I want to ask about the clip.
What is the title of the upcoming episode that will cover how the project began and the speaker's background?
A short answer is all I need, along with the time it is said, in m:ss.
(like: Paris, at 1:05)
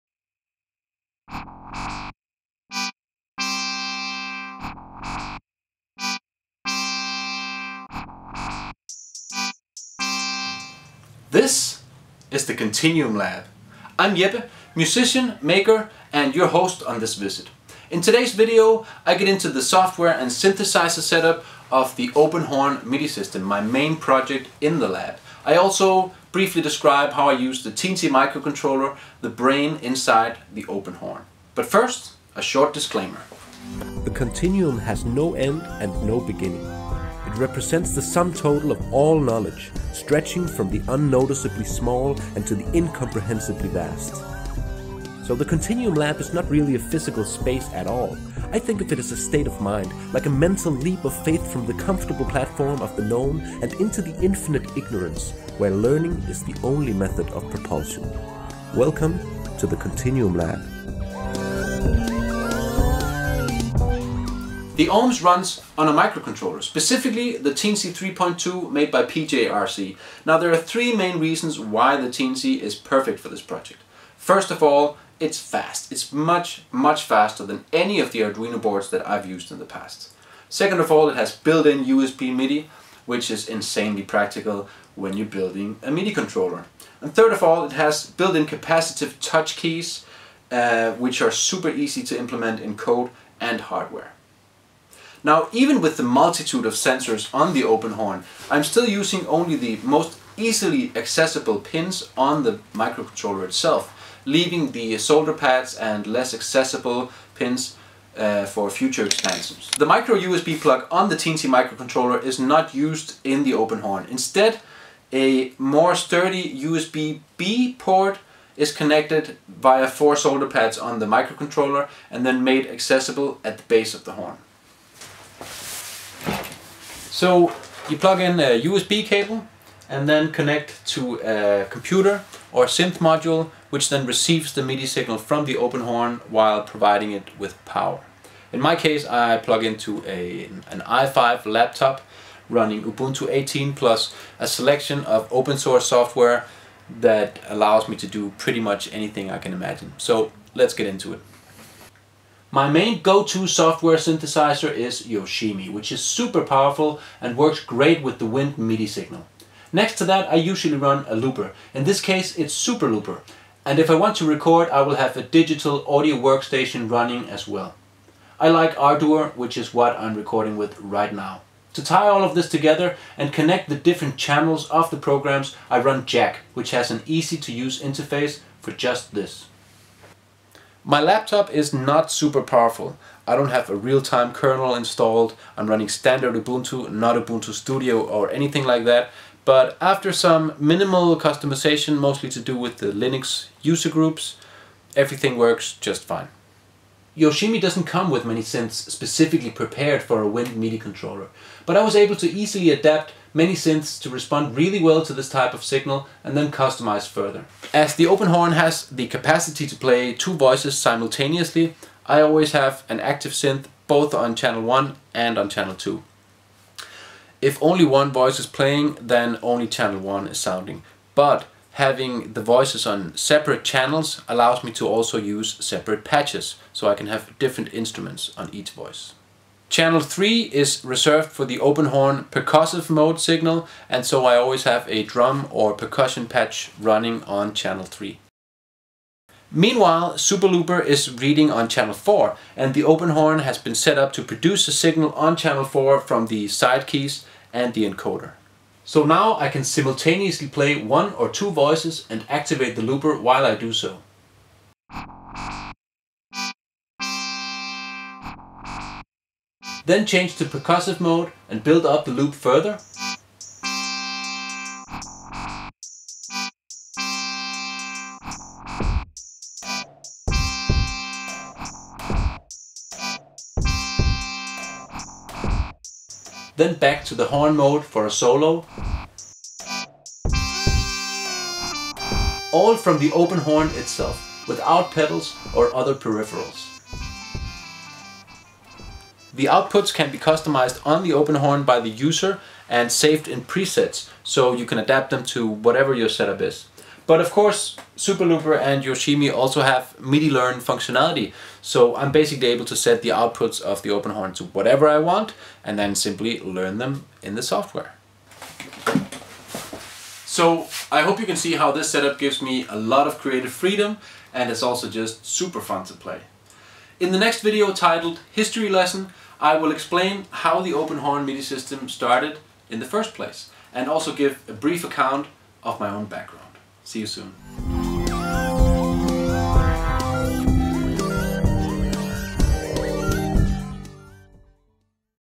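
History Lesson, at 5:18.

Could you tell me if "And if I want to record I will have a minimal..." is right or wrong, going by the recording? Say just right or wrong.
wrong.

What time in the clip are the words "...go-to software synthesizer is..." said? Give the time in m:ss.
2:33.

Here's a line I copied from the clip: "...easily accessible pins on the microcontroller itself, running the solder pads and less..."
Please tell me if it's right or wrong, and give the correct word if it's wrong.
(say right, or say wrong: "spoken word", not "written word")
wrong: "leaving", not "running".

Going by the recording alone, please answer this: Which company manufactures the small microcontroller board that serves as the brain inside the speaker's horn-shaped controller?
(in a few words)
PJRC.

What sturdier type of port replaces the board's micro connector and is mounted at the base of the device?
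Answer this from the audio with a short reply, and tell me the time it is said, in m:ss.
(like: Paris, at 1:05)
USB-B, at 1:56.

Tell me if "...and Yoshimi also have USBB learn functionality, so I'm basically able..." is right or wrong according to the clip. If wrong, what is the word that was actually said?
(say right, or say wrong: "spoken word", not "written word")
wrong: "MIDI", not "USBB".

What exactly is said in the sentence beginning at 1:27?
And third of all, it has built-in capacitive touch keys, uh, which are super easy to implement in code and hardware.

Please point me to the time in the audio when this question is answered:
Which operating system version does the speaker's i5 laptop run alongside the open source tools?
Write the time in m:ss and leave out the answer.
2:22.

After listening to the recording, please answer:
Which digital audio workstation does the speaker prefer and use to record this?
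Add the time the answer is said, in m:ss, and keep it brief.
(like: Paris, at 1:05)
Ardour, at 2:48.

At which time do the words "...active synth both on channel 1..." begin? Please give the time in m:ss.
3:32.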